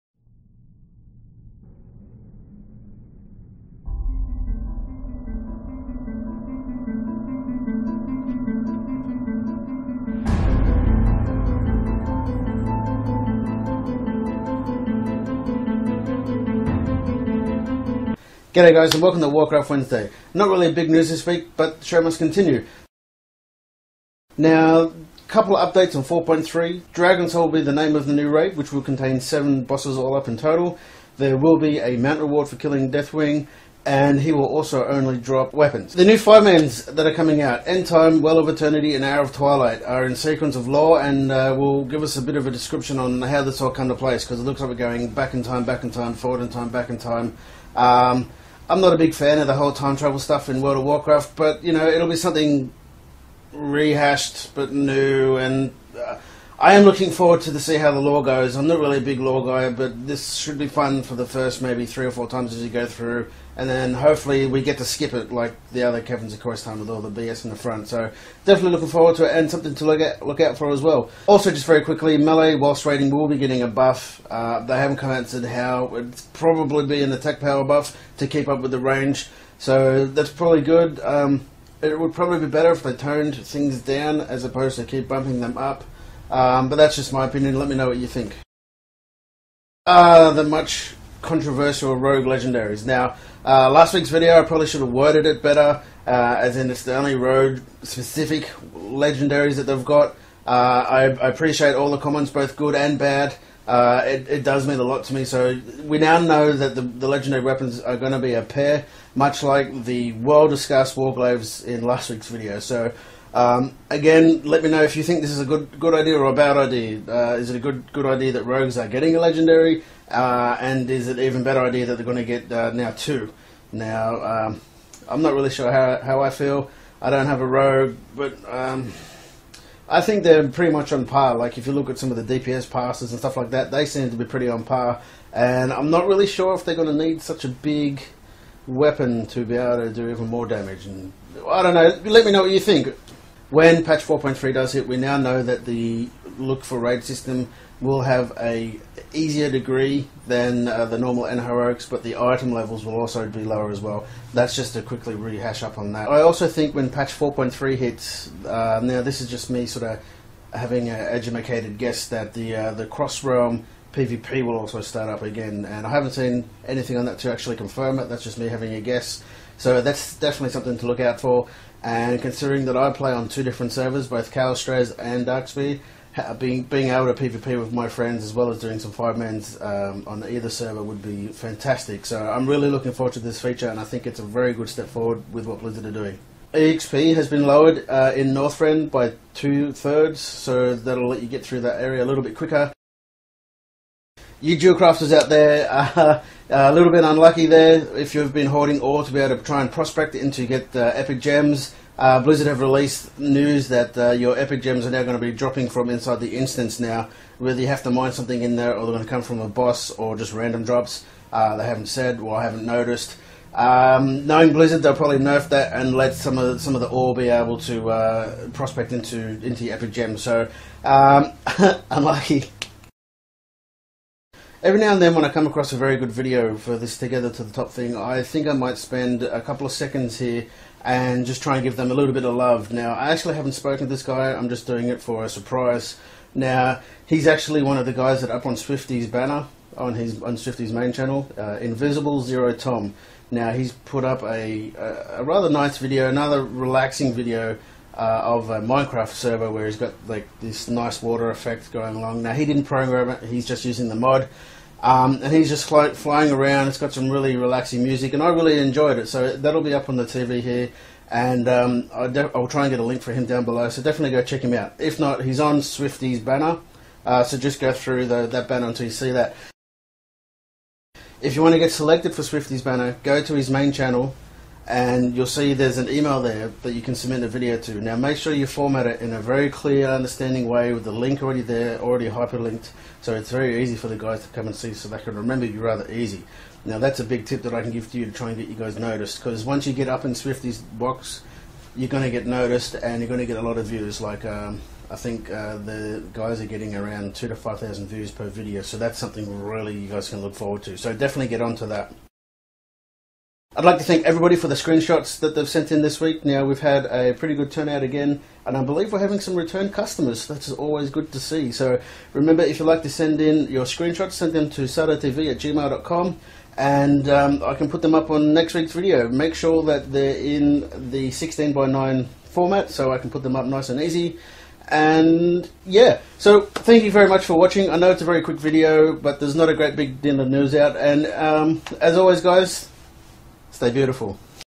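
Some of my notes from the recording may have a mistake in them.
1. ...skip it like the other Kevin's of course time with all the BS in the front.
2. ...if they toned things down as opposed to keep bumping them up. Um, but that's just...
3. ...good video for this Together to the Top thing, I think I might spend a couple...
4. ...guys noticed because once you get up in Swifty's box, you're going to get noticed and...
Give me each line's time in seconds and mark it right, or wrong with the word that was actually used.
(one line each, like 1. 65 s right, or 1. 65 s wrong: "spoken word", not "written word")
1. 64 s right
2. 82 s right
3. 225 s right
4. 288 s right.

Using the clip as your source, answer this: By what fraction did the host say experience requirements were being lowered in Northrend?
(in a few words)
Two thirds.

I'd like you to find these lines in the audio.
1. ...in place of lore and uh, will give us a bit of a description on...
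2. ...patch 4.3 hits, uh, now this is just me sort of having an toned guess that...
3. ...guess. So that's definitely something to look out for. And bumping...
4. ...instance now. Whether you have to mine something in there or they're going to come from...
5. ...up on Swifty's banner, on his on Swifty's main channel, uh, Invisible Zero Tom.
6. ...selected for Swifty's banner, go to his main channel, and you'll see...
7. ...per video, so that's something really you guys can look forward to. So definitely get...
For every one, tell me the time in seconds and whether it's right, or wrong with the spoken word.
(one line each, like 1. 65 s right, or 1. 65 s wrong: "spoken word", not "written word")
1. 40 s wrong: "sequence", not "place"
2. 156 s wrong: "educated", not "toned"
3. 168 s wrong: "considering", not "bumping"
4. 206 s right
5. 238 s right
6. 271 s right
7. 298 s right.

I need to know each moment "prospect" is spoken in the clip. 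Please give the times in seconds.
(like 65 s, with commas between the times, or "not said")
199 s, 218 s.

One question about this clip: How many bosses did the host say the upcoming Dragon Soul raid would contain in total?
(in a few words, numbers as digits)
7.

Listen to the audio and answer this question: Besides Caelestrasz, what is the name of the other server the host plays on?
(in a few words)
Darkspeed.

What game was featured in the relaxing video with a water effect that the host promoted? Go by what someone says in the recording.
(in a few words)
Minecraft.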